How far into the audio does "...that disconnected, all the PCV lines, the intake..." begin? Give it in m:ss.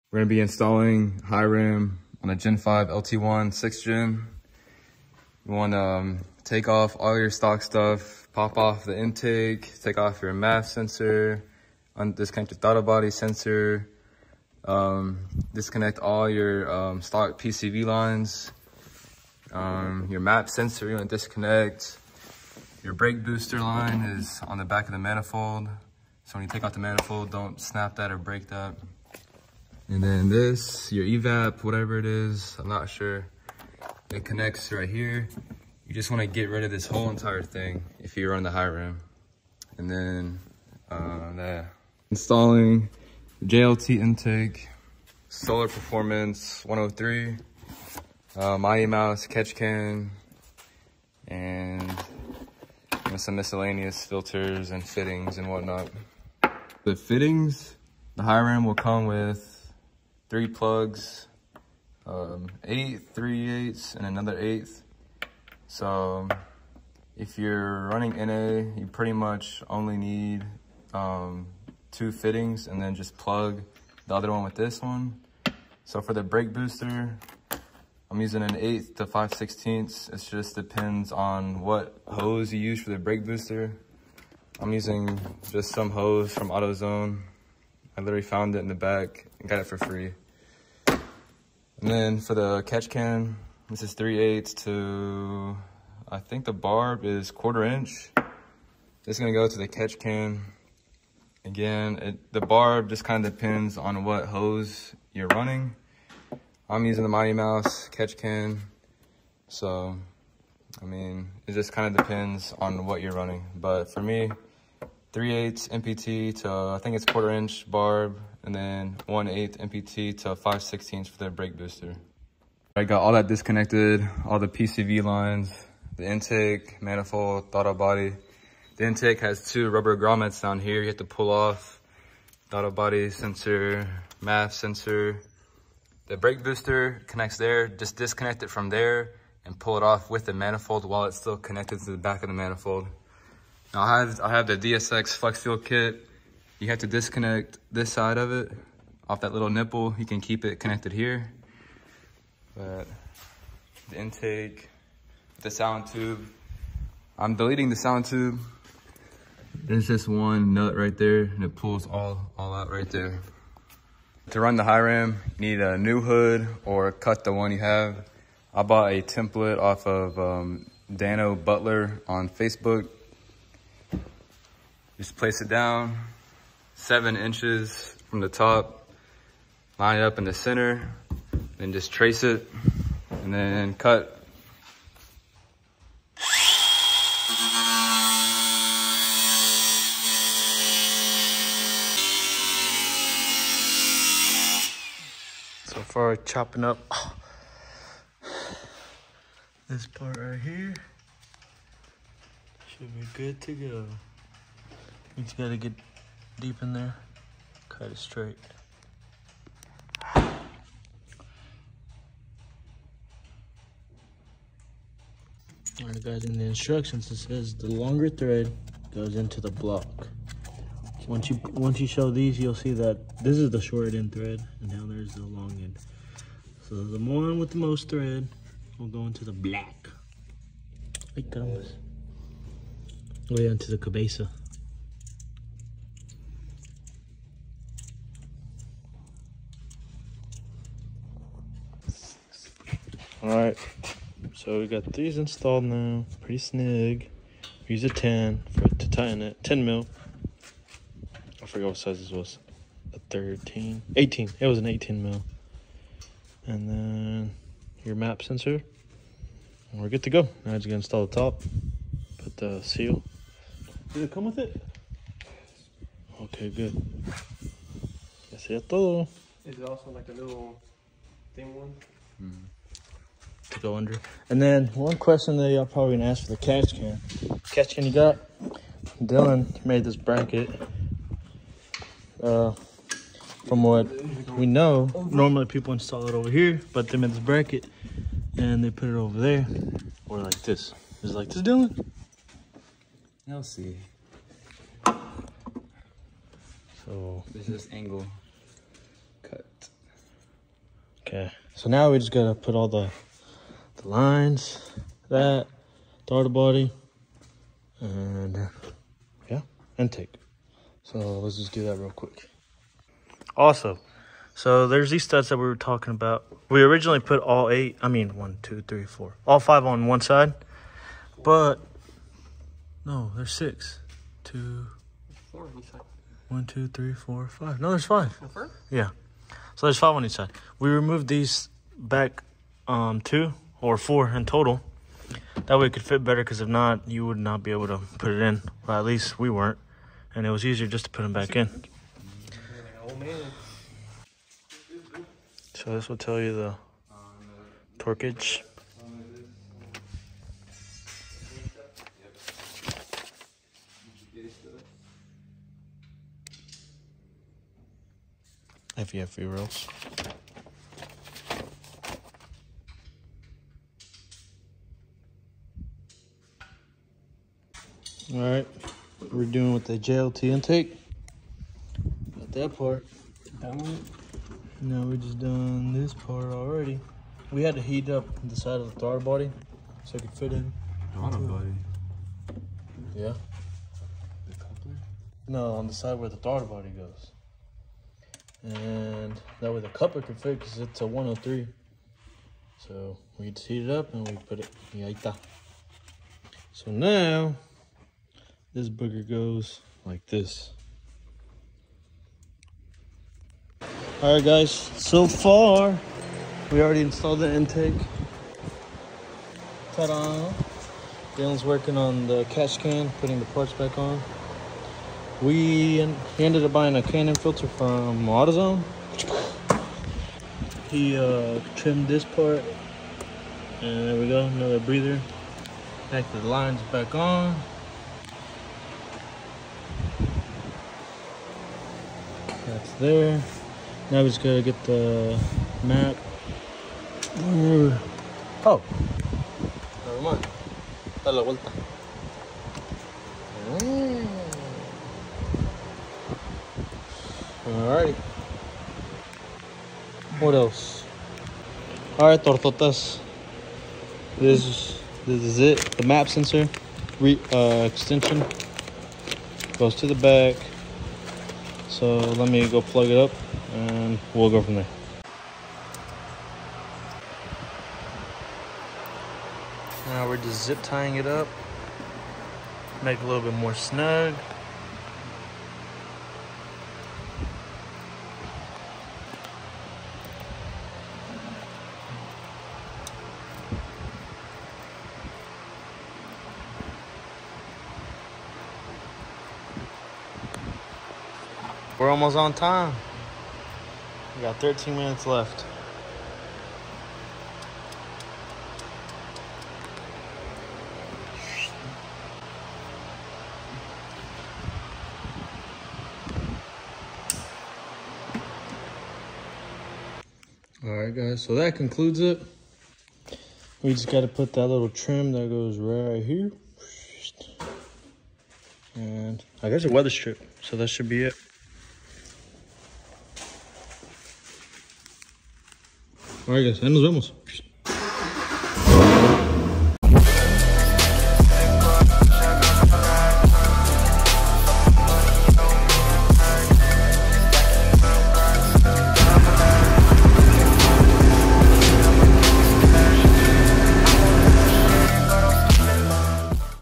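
2:03.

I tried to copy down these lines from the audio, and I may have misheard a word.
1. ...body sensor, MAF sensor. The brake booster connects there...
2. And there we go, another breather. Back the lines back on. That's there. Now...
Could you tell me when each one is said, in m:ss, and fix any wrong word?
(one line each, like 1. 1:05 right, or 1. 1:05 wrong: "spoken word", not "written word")
1. 2:12 right
2. 7:03 right.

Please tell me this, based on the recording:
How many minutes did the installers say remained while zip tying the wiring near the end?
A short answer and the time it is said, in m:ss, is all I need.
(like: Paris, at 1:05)
13, at 8:14.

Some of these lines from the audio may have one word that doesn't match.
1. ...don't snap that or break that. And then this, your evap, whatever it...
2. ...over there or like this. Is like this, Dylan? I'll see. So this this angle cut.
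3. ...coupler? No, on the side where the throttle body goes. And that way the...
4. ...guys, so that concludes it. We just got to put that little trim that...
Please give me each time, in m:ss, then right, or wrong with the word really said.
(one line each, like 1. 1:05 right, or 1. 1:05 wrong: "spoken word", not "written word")
1. 0:27 right
2. 4:48 right
3. 6:24 right
4. 8:30 right.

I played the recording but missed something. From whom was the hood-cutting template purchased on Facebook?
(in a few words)
Dano Butler.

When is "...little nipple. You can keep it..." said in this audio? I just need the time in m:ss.
2:29.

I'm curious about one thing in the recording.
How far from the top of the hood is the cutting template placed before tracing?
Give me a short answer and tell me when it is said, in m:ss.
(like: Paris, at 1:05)
7 inches, at 2:56.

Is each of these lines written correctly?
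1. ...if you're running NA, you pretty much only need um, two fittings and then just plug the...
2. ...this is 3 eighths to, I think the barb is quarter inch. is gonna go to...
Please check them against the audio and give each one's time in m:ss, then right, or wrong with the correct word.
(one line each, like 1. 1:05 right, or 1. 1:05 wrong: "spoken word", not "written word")
1. 1:07 right
2. 1:33 right.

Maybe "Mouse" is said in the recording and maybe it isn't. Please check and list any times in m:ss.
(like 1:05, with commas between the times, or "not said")
0:48, 1:47.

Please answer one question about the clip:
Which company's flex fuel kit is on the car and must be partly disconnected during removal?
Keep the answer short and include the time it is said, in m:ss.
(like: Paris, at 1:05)
DSX, at 2:24.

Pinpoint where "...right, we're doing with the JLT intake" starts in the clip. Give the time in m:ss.
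6:08.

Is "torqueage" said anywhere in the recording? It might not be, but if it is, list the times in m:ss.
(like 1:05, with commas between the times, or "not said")
5:47.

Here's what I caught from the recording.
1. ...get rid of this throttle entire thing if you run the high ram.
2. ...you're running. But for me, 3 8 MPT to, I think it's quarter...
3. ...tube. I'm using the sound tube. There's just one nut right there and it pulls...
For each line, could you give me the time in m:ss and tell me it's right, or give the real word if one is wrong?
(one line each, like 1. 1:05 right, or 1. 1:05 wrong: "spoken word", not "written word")
1. 0:36 wrong: "whole", not "throttle"
2. 1:53 right
3. 2:35 wrong: "deleting", not "using".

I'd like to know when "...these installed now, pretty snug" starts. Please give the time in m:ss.
4:04.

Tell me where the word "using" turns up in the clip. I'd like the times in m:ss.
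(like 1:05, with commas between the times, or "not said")
1:18, 1:24, 1:46.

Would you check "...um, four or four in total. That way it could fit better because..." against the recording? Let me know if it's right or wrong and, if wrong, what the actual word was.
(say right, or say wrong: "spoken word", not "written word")
wrong: "two", not "four".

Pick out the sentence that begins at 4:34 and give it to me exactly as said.
And then one question that y'all probably gonna ask for the catch can.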